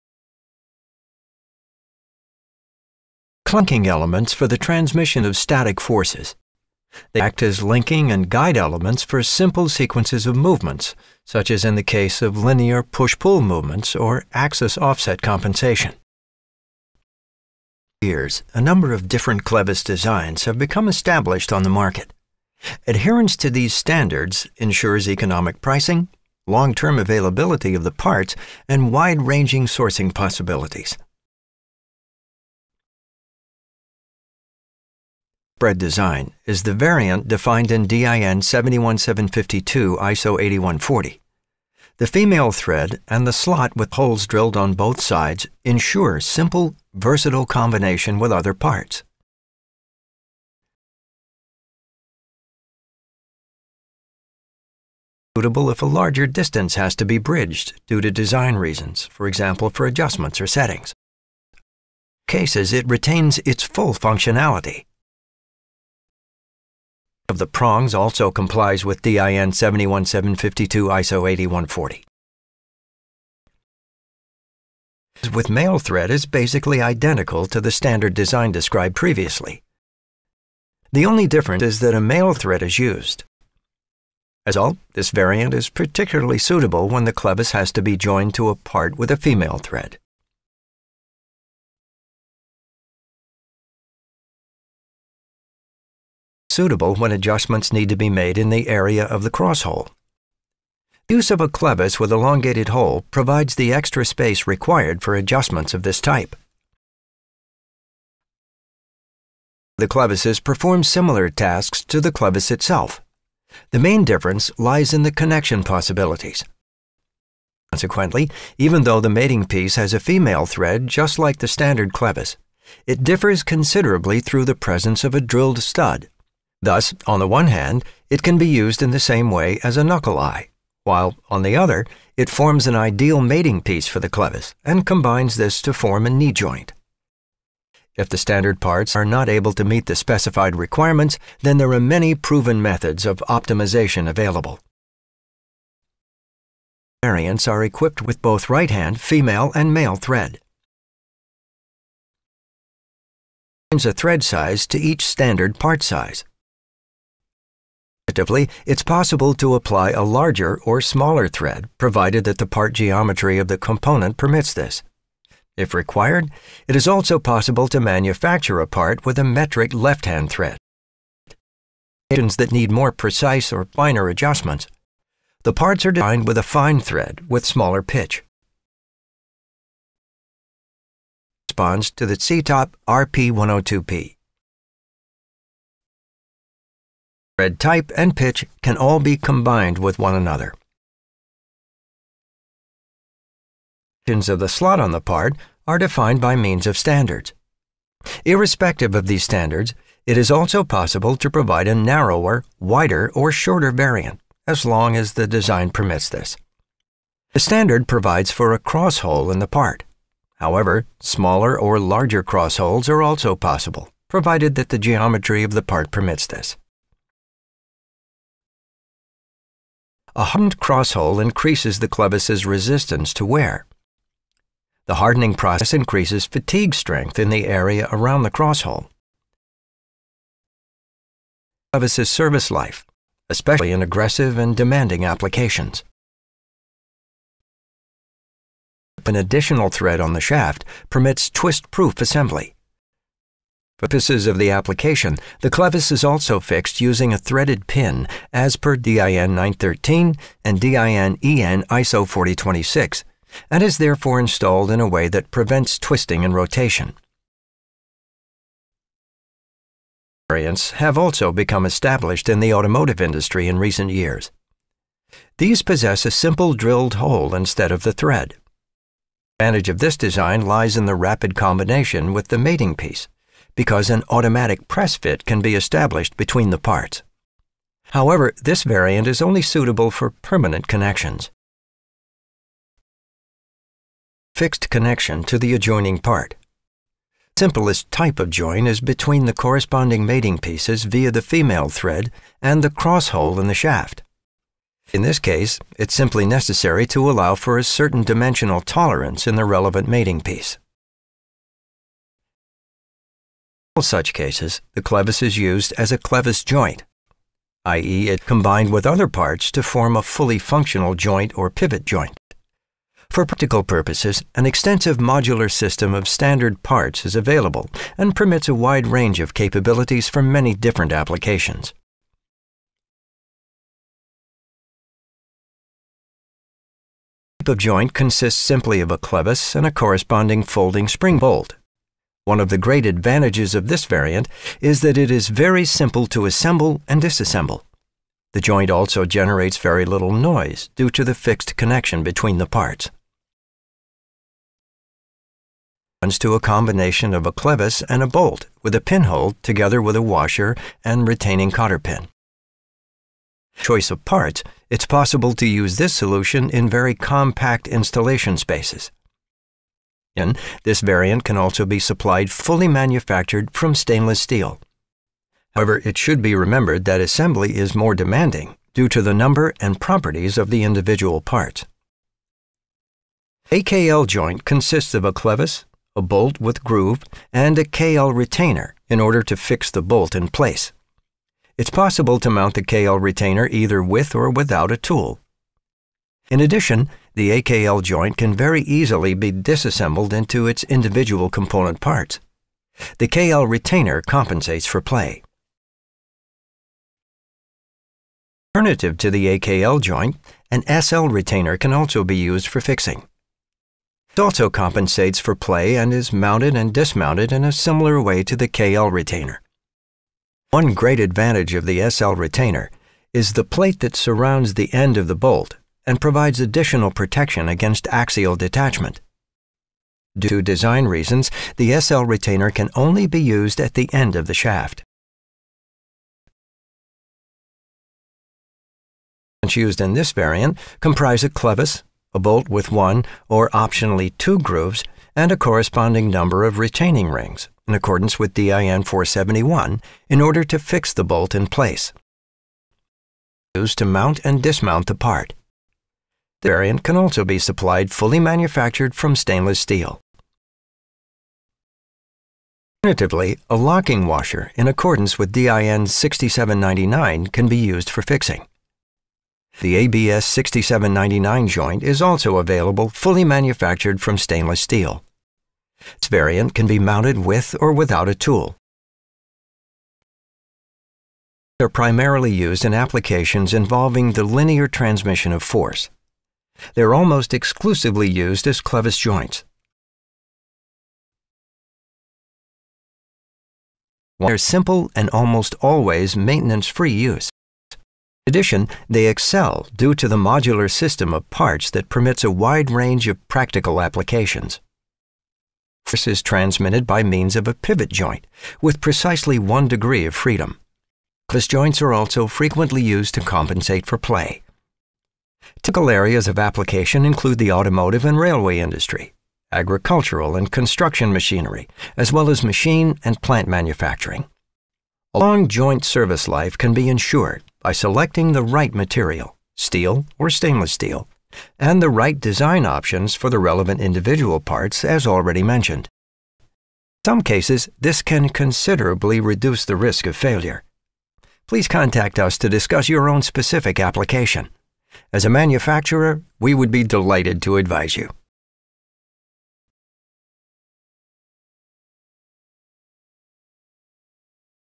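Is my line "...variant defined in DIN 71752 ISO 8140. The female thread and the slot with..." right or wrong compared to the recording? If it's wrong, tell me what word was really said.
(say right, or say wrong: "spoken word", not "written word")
right.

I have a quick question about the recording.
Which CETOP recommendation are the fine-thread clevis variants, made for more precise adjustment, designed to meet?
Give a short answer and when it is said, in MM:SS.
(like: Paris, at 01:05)
CETOP RP102P, at 03:02.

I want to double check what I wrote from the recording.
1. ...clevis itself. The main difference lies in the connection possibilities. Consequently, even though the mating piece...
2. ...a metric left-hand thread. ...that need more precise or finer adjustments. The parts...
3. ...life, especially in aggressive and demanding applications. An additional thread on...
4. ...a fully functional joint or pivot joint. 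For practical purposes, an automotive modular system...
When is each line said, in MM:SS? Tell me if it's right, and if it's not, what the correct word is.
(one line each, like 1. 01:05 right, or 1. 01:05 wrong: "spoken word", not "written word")
1. 01:52 right
2. 02:49 right
3. 03:52 right
4. 05:09 wrong: "extensive", not "automotive".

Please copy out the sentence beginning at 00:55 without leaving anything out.
Suitable if a larger distance has to be bridged due to design reasons, for example for adjustments or settings.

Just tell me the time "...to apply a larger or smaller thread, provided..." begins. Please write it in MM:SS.
02:39.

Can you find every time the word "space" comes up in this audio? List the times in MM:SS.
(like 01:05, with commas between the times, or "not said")
01:44, 05:58.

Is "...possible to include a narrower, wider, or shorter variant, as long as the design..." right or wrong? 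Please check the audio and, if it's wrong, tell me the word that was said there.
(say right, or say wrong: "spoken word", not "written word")
wrong: "provide", not "include".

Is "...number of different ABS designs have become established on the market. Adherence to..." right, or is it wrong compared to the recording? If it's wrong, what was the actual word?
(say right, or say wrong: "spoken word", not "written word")
wrong: "Clevis", not "ABS".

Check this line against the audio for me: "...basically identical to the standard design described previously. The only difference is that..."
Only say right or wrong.
right.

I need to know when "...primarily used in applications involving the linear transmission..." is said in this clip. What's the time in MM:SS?
07:51.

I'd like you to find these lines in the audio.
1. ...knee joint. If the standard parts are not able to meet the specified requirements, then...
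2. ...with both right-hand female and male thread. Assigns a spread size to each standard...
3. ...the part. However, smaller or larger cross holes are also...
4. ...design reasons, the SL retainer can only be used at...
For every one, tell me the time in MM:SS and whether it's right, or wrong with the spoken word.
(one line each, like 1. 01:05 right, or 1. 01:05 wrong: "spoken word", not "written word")
1. 02:16 right
2. 02:28 wrong: "thread", not "spread"
3. 03:29 right
4. 07:00 right.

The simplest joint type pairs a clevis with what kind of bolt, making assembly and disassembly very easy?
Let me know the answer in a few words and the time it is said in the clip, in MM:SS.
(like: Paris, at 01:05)
folding spring bolt, at 05:30.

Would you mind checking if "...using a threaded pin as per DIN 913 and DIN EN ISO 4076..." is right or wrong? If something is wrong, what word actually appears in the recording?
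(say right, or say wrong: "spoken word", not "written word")
wrong: "4026", not "4076".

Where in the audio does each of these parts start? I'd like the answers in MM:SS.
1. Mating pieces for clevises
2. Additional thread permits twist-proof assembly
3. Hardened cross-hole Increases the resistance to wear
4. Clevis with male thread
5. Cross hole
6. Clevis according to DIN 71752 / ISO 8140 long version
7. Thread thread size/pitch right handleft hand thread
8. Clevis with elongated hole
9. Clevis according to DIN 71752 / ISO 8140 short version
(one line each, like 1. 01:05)
1. 01:50
2. 03:58
3. 03:39
4. 01:15
5. 03:27
6. 00:54
7. 02:27
8. 01:35
9. 00:34.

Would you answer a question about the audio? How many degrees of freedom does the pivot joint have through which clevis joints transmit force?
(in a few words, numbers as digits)
1.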